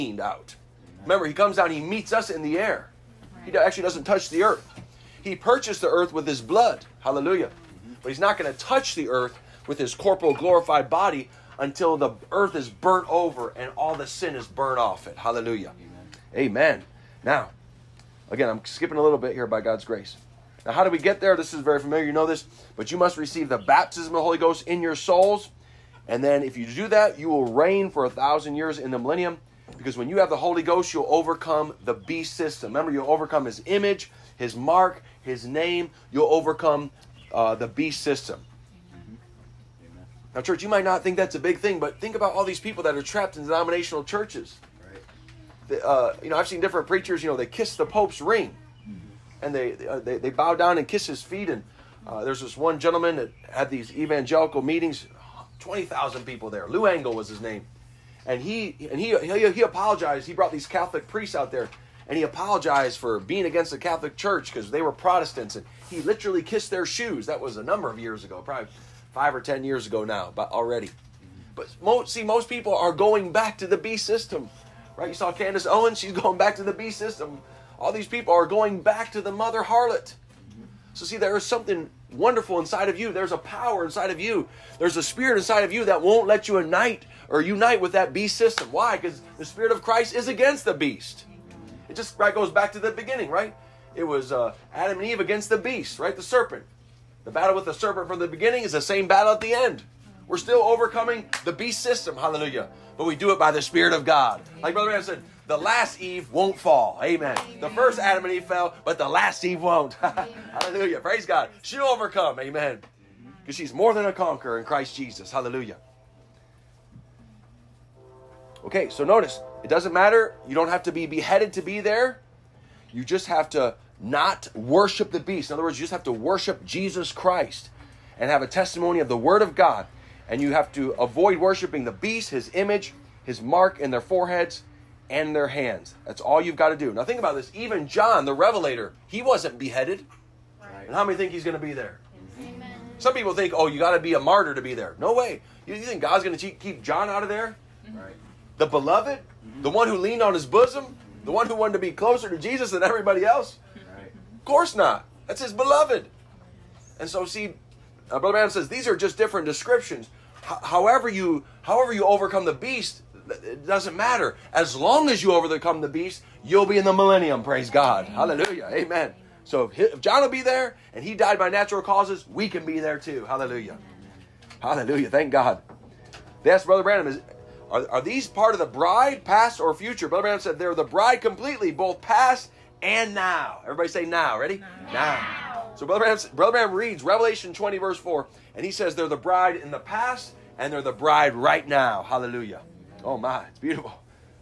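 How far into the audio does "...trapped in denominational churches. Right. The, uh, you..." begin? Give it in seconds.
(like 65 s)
43 s.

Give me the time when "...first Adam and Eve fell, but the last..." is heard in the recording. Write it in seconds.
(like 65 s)
107 s.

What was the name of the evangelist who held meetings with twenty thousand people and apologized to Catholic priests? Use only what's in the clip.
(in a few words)
Lou Engle.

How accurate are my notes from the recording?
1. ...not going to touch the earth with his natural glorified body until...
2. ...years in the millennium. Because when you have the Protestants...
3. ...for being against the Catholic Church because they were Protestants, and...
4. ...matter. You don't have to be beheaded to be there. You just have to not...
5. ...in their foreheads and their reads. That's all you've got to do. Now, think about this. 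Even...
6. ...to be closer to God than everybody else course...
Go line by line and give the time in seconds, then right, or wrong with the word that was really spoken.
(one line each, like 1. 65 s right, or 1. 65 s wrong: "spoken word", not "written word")
1. 8 s wrong: "corporal", not "natural"
2. 28 s wrong: "Holy", not "Protestants"
3. 62 s right
4. 119 s right
5. 133 s wrong: "hands", not "reads"
6. 151 s wrong: "Jesus", not "God".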